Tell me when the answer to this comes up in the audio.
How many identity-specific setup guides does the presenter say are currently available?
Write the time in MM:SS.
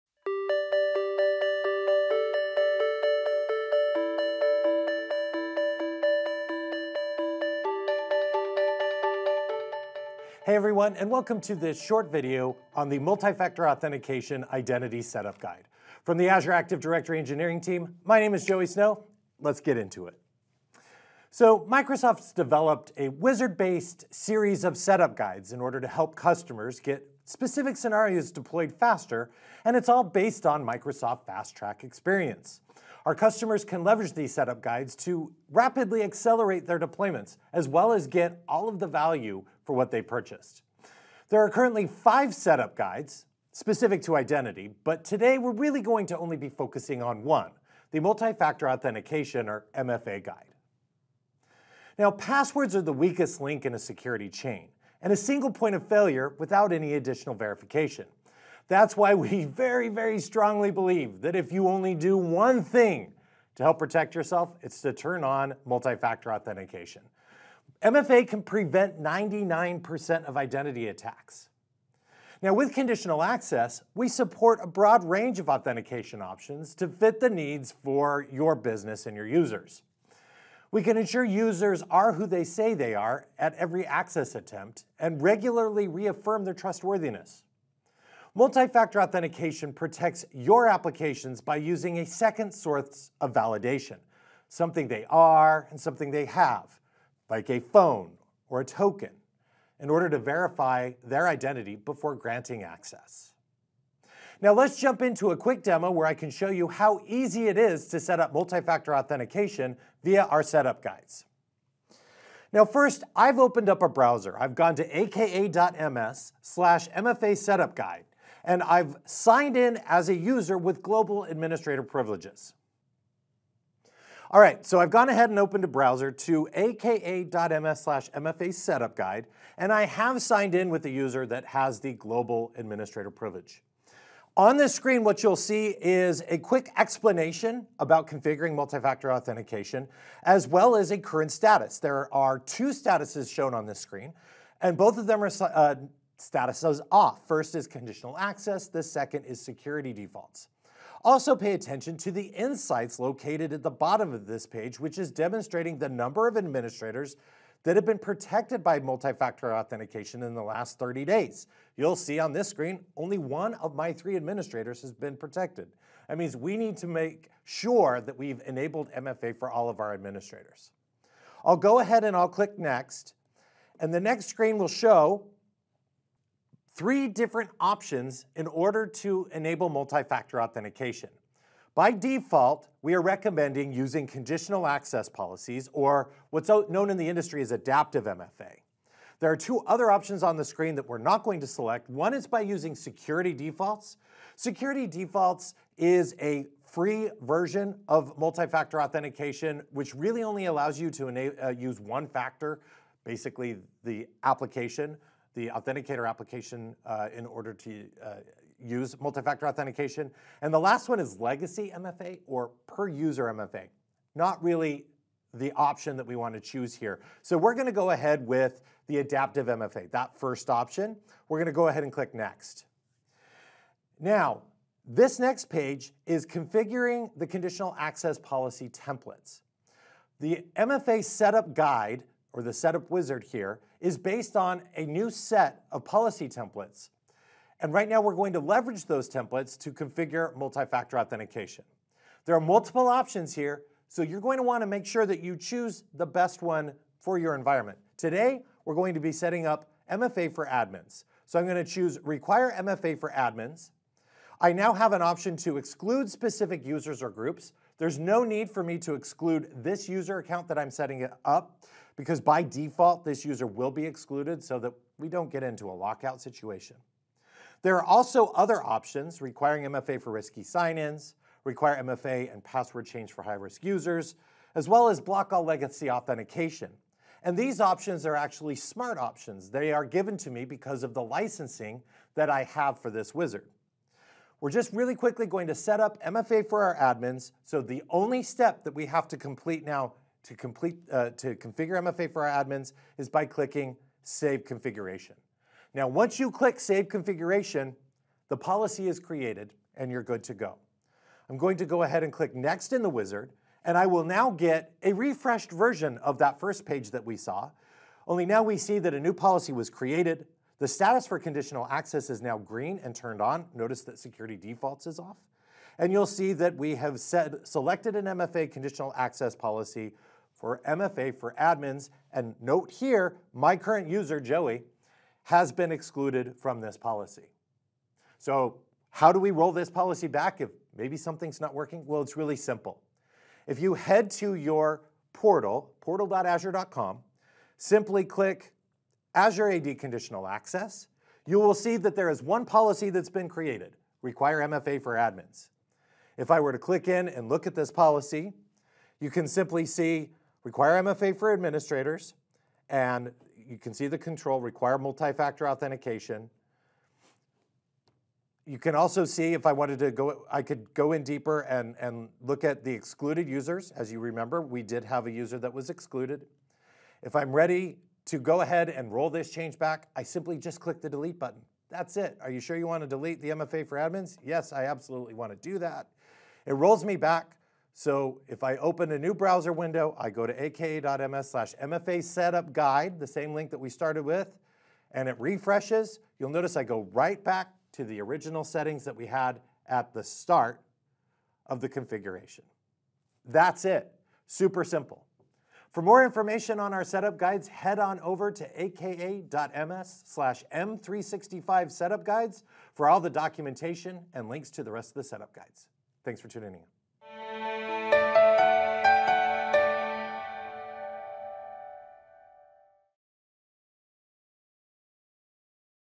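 00:41.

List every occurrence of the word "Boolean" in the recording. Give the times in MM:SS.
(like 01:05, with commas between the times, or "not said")
not said.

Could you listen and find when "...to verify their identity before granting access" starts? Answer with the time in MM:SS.
01:40.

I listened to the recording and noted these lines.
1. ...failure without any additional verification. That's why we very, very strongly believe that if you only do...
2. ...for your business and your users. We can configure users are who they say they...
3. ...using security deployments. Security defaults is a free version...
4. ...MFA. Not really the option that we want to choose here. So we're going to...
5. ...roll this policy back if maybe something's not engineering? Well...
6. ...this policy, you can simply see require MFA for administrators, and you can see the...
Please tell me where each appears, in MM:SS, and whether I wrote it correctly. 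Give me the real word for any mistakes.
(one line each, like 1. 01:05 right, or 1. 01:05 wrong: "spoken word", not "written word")
1. 00:55 right
2. 01:17 wrong: "ensure", not "configure"
3. 03:12 wrong: "defaults", not "deployments"
4. 03:33 right
5. 05:29 wrong: "working", not "engineering"
6. 05:47 right.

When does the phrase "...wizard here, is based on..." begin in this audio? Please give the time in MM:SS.
03:52.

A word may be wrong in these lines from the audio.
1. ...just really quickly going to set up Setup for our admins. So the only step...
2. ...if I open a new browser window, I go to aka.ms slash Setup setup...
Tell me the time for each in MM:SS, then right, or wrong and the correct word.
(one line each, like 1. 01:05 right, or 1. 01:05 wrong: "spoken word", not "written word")
1. 04:44 wrong: "MFA", not "Setup"
2. 06:18 wrong: "MFA", not "Setup".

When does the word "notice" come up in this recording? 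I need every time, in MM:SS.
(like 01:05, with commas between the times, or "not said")
05:13, 06:26.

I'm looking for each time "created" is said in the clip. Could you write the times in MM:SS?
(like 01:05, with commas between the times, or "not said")
04:58, 05:09, 05:43.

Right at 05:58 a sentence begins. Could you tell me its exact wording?
You can also see if I wanted to go, I could go in deeper and, and look at the excluded users.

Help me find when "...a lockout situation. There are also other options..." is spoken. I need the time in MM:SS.
04:25.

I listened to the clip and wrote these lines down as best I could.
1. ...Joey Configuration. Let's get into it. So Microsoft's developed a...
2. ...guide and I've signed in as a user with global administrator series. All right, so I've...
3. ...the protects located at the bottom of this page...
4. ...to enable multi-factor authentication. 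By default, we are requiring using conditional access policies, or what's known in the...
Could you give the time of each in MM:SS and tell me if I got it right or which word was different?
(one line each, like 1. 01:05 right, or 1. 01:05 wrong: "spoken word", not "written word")
1. 00:18 wrong: "Snow", not "Configuration"
2. 01:57 wrong: "privileges", not "series"
3. 02:32 wrong: "insights", not "protects"
4. 02:58 wrong: "recommending", not "requiring".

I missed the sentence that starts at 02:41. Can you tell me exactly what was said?
You'll see on this screen, only one of my three administrators has been protected.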